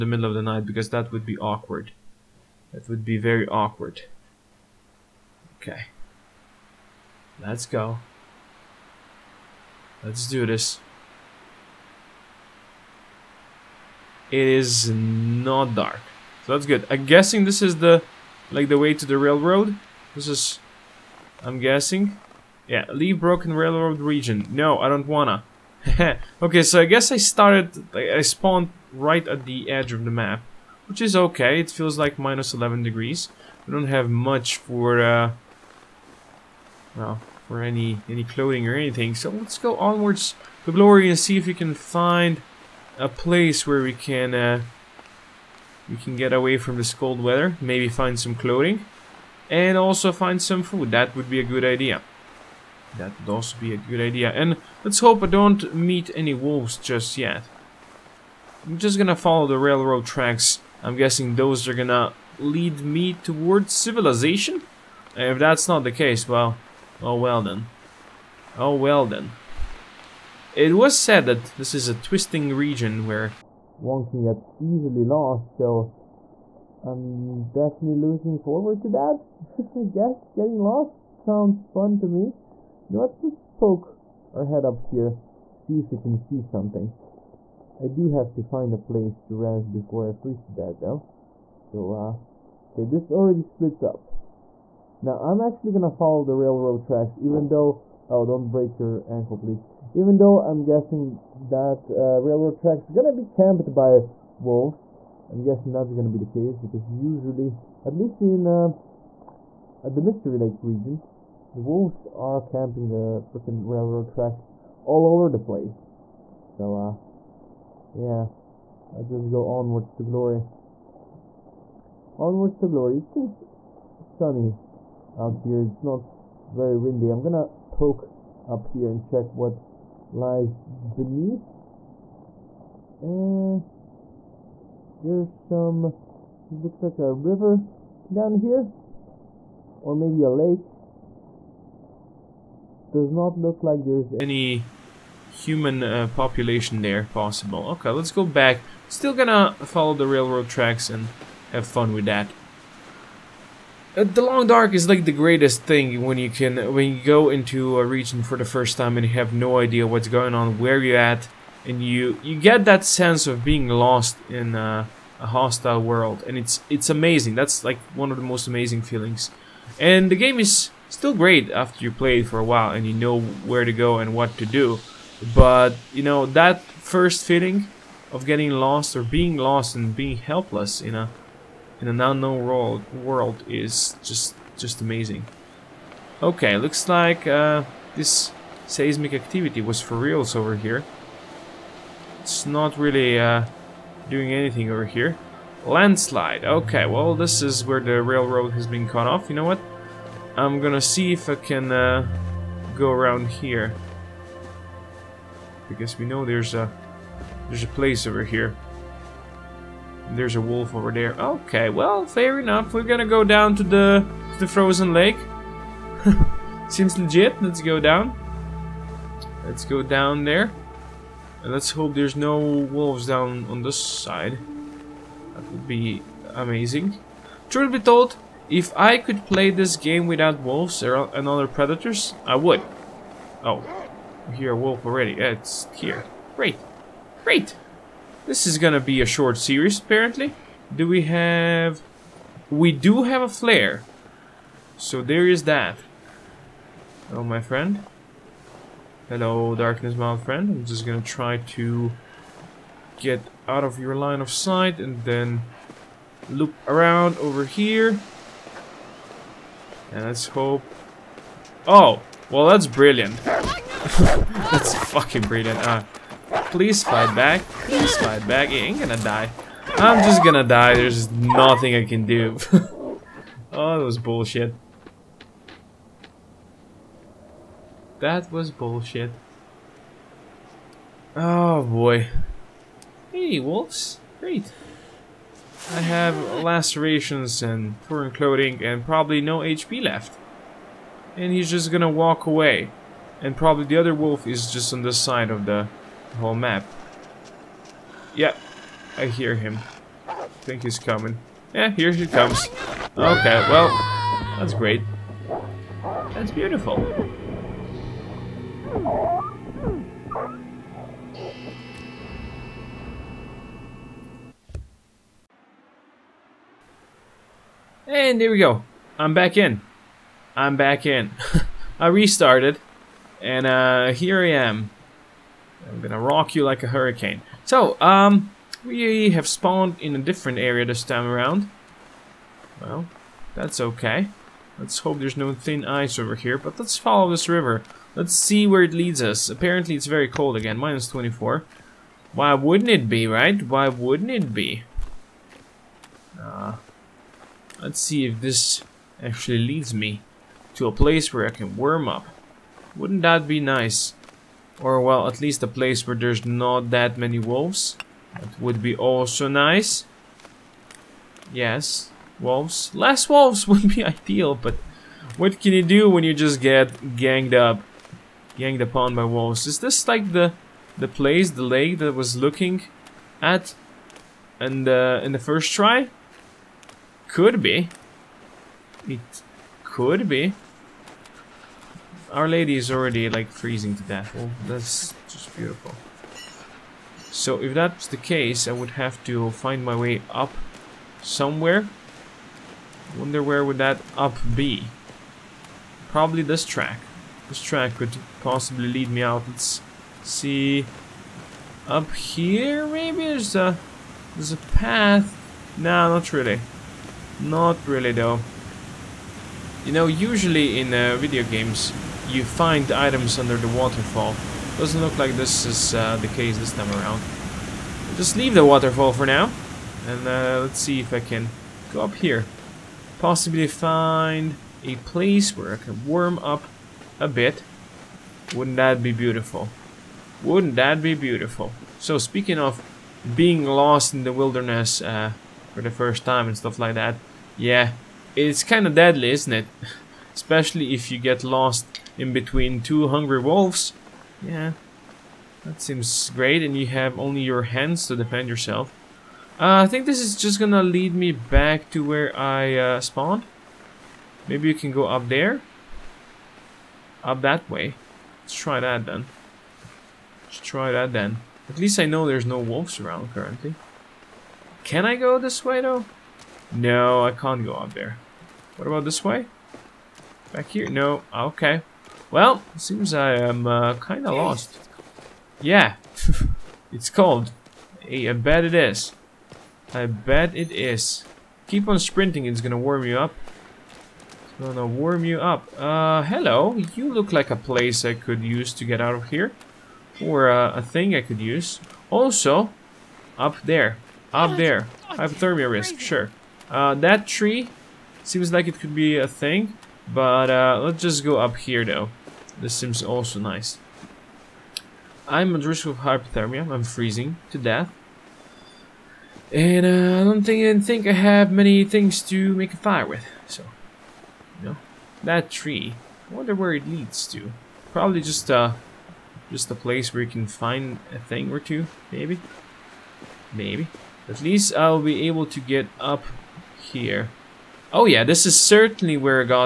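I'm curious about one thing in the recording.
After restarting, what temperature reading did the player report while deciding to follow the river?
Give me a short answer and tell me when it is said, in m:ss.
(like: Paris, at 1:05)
-24, at 5:40.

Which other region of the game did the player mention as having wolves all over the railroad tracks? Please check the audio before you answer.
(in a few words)
Mystery Lake.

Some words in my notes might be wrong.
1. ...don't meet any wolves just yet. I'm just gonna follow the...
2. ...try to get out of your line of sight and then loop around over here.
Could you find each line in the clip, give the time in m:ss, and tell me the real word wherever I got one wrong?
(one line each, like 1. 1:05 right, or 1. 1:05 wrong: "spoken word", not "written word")
1. 0:55 right
2. 4:11 right.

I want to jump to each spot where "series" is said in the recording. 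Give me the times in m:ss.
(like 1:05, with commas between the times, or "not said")
3:59.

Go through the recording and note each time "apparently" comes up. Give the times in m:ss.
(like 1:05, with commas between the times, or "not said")
3:59, 5:39.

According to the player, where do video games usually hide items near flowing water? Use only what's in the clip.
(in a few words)
Under the waterfall.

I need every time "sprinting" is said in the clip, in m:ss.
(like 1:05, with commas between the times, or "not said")
8:01.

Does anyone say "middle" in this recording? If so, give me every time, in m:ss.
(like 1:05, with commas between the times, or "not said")
0:00.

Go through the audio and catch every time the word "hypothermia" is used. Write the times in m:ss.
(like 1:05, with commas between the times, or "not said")
8:14, 8:25.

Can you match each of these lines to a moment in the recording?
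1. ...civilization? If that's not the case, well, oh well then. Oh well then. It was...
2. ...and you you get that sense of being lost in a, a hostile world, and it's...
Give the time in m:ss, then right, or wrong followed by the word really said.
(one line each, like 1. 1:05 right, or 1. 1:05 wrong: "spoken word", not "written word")
1. 1:03 right
2. 2:41 right.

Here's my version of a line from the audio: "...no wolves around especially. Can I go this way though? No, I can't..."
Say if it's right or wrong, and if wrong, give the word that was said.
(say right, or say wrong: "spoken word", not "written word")
wrong: "currently", not "especially".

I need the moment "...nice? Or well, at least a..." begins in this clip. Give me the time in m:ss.
5:53.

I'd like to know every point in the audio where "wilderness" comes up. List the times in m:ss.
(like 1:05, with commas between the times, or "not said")
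7:14.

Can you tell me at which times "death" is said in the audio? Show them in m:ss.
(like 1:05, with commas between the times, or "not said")
1:30, 6:23, 8:27.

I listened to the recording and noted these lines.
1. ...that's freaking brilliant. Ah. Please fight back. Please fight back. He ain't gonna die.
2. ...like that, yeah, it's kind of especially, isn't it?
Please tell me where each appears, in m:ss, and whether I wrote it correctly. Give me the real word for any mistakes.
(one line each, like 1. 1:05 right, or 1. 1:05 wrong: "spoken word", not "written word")
1. 4:23 wrong: "fucking", not "freaking"
2. 7:16 wrong: "deadly", not "especially".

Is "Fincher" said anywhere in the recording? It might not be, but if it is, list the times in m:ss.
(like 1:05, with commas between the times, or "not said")
not said.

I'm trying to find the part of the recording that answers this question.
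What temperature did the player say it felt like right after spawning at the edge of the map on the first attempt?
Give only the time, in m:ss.
0:32.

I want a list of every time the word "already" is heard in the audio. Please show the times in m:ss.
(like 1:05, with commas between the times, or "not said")
1:33, 3:54, 6:22.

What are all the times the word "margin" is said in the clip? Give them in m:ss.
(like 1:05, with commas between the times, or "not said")
not said.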